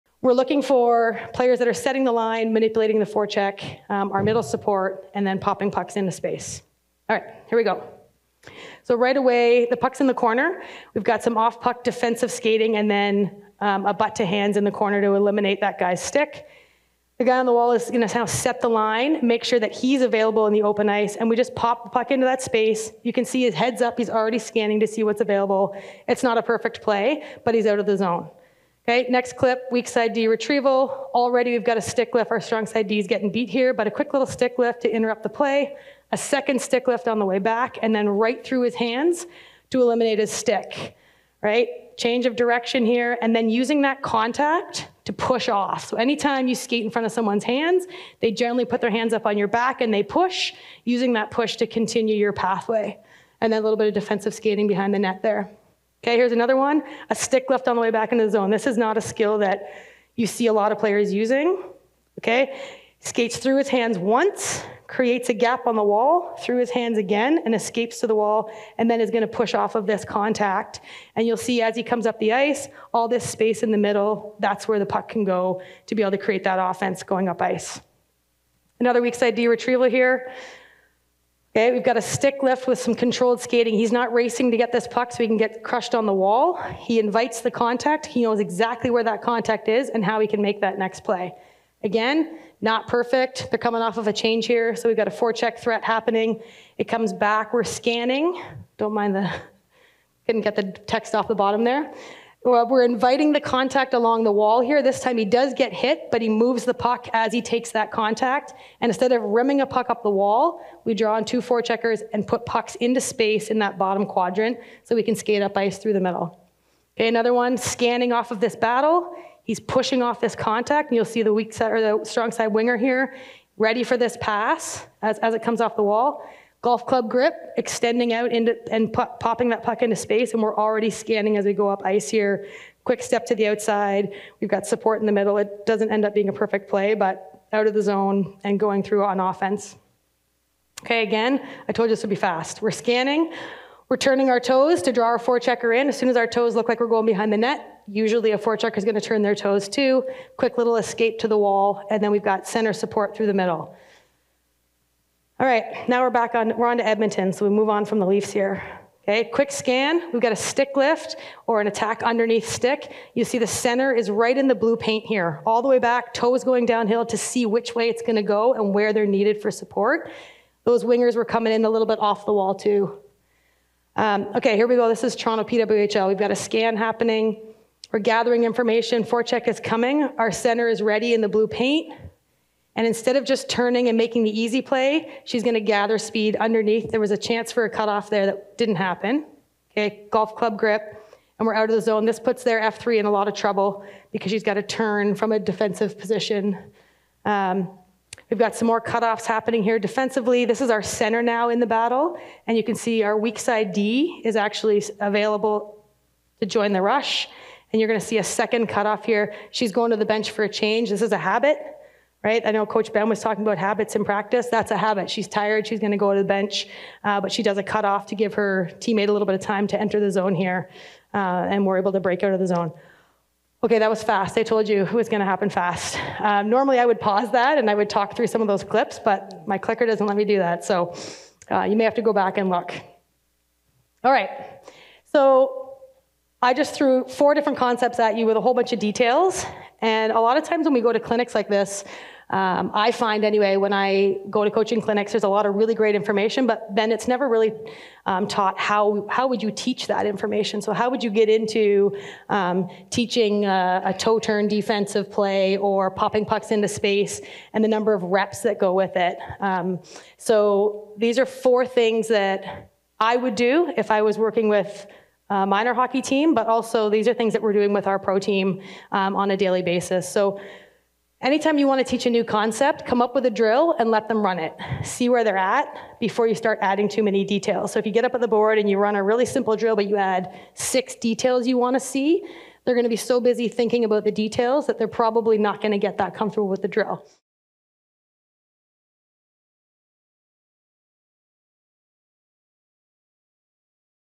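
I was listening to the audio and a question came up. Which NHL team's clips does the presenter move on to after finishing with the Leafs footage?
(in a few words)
Edmonton.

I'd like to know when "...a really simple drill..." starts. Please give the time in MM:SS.
04:38.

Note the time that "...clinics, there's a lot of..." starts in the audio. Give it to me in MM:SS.
04:04.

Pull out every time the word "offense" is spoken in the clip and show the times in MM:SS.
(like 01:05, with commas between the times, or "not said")
01:16, 02:19.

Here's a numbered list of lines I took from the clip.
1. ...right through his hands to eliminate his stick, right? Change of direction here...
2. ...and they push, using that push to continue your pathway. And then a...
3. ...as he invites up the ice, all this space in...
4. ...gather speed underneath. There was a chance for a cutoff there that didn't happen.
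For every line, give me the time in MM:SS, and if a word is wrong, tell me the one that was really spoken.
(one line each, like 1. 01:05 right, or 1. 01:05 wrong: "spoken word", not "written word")
1. 00:38 right
2. 00:49 right
3. 01:11 wrong: "comes", not "invites"
4. 03:05 right.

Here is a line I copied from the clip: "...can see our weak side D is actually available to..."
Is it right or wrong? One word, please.
right.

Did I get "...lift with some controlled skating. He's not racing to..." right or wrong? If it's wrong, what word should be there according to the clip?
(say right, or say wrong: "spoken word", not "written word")
right.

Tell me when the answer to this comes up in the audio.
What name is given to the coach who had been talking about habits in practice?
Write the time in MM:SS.
03:32.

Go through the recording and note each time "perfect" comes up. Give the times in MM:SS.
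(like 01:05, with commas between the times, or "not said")
00:26, 01:32, 02:16.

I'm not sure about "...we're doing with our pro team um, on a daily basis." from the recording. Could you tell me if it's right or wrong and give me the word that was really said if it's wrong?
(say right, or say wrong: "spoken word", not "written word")
right.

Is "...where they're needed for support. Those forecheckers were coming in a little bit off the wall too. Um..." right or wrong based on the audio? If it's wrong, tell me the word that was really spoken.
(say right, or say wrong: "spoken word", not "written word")
wrong: "wingers", not "forecheckers".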